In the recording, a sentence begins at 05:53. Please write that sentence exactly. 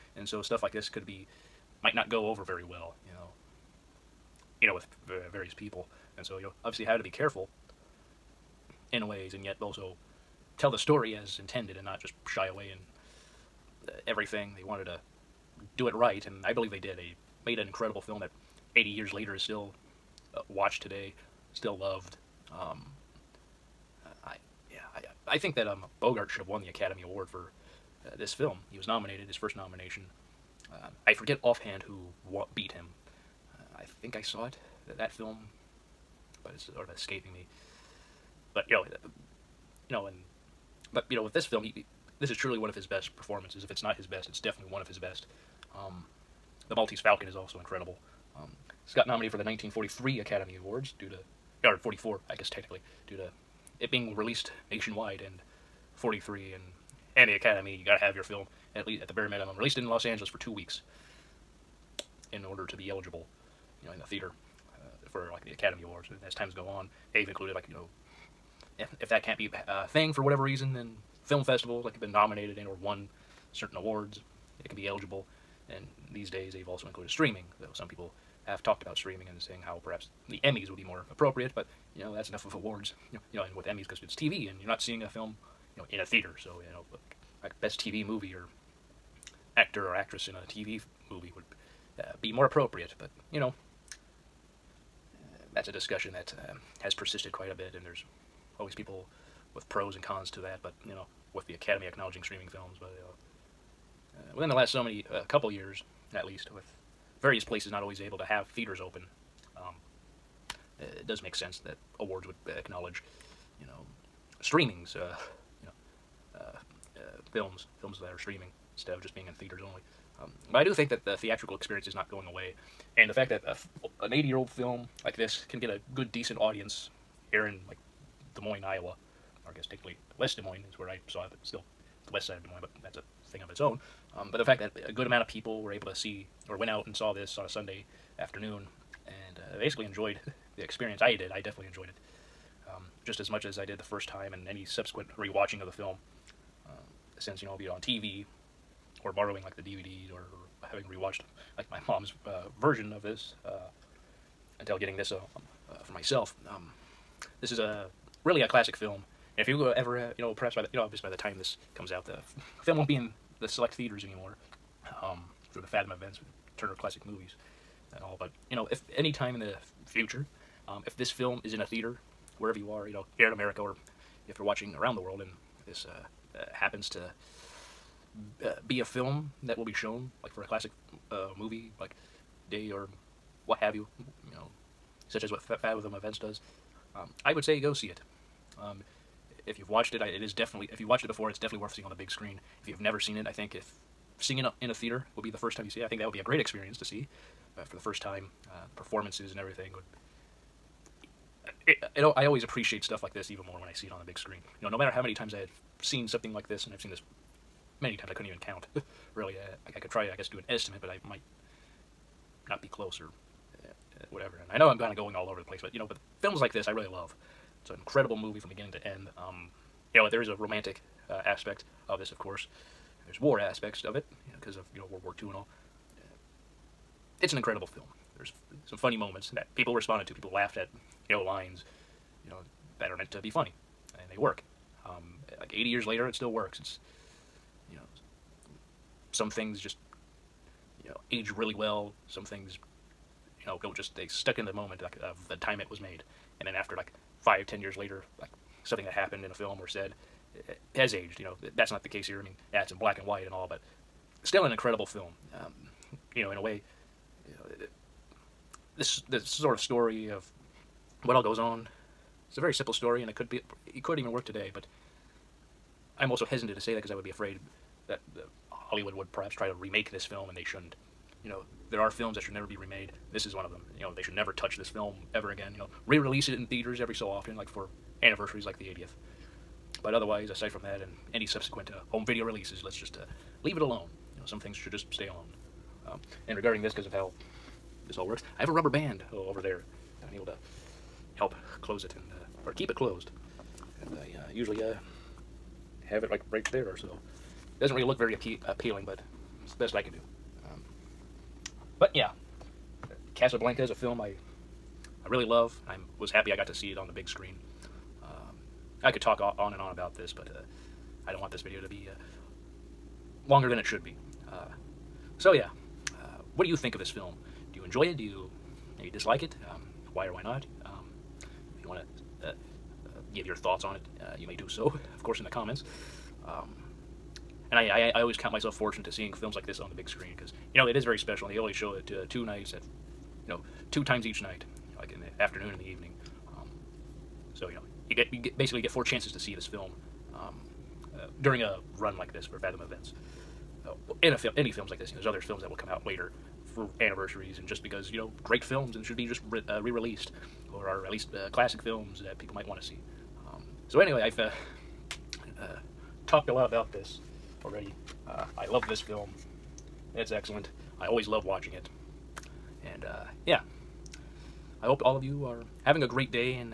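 Um, so anyway, I've uh, uh, talked a lot about this already.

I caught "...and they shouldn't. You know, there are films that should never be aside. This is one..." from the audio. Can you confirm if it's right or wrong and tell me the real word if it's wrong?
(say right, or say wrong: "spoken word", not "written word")
wrong: "remade", not "aside".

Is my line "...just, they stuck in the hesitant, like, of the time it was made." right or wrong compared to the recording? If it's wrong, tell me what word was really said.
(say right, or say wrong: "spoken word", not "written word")
wrong: "moment", not "hesitant".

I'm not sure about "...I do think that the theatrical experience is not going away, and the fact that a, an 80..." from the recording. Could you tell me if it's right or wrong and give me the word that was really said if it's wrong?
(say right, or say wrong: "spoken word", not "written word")
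right.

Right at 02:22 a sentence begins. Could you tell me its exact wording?
Um, just as much as I did the first time and any subsequent rewatching of the film.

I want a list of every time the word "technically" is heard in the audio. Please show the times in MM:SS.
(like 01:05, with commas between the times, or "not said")
00:52, 02:09.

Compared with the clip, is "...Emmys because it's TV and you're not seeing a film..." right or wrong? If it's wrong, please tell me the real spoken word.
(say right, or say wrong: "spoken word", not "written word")
right.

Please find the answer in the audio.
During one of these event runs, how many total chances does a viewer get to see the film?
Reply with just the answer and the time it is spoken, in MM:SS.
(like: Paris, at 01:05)
4, at 05:38.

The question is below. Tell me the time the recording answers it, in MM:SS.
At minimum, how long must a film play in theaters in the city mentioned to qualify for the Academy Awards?
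01:00.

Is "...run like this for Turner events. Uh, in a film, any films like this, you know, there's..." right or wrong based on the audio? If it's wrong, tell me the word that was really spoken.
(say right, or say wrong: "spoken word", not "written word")
wrong: "Fathom", not "Turner".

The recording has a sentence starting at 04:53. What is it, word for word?
And I uh, usually uh, have it like right there or so.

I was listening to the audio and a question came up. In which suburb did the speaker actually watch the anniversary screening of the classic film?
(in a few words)
West Des Moines.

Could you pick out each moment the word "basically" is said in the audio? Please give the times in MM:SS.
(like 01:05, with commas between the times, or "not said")
02:19, 05:38.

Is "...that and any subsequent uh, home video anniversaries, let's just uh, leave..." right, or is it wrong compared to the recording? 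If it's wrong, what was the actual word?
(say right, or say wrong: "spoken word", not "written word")
wrong: "releases", not "anniversaries".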